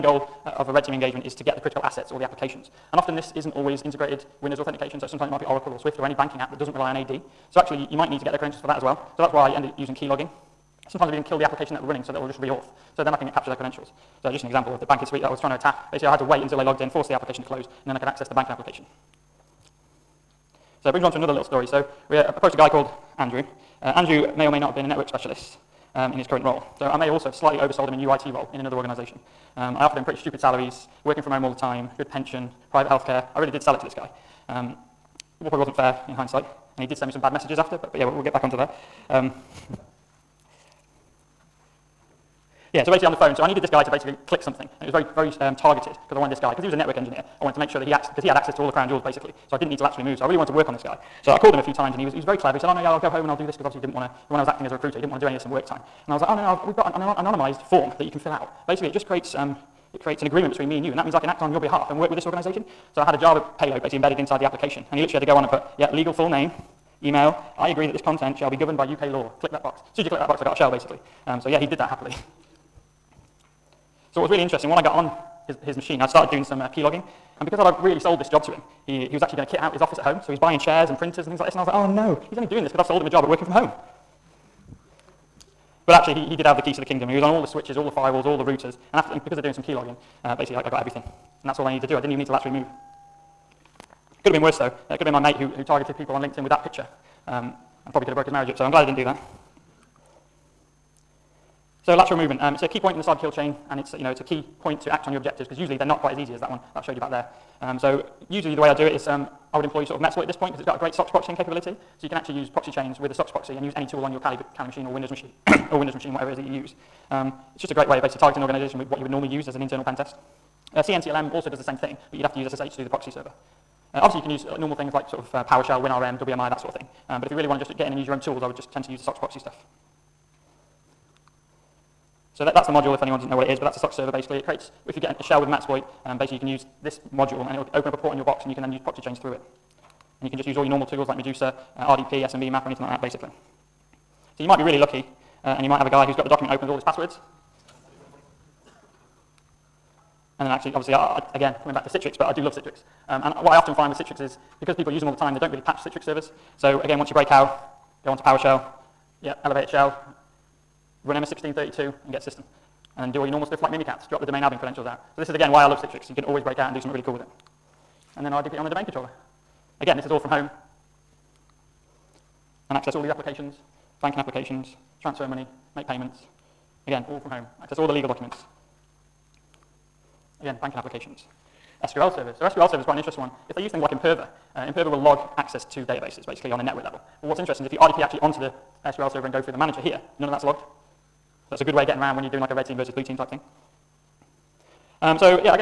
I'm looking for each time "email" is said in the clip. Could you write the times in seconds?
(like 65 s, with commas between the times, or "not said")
67 s.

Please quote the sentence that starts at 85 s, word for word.
But actually, he, he did have the keys to the kingdom.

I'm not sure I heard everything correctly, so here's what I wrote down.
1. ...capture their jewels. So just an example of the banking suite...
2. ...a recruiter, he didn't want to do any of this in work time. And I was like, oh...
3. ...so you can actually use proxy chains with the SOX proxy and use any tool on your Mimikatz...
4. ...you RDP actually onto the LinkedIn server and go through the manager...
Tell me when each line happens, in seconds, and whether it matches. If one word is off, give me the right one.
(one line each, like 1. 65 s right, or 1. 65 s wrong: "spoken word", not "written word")
1. 13 s wrong: "credentials", not "jewels"
2. 54 s right
3. 111 s wrong: "Kali", not "Mimikatz"
4. 187 s wrong: "SQL", not "LinkedIn".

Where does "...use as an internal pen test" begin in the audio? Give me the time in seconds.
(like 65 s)
119 s.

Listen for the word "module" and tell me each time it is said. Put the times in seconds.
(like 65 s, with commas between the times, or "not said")
132 s, 137 s.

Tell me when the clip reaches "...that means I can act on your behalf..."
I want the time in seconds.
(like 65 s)
60 s.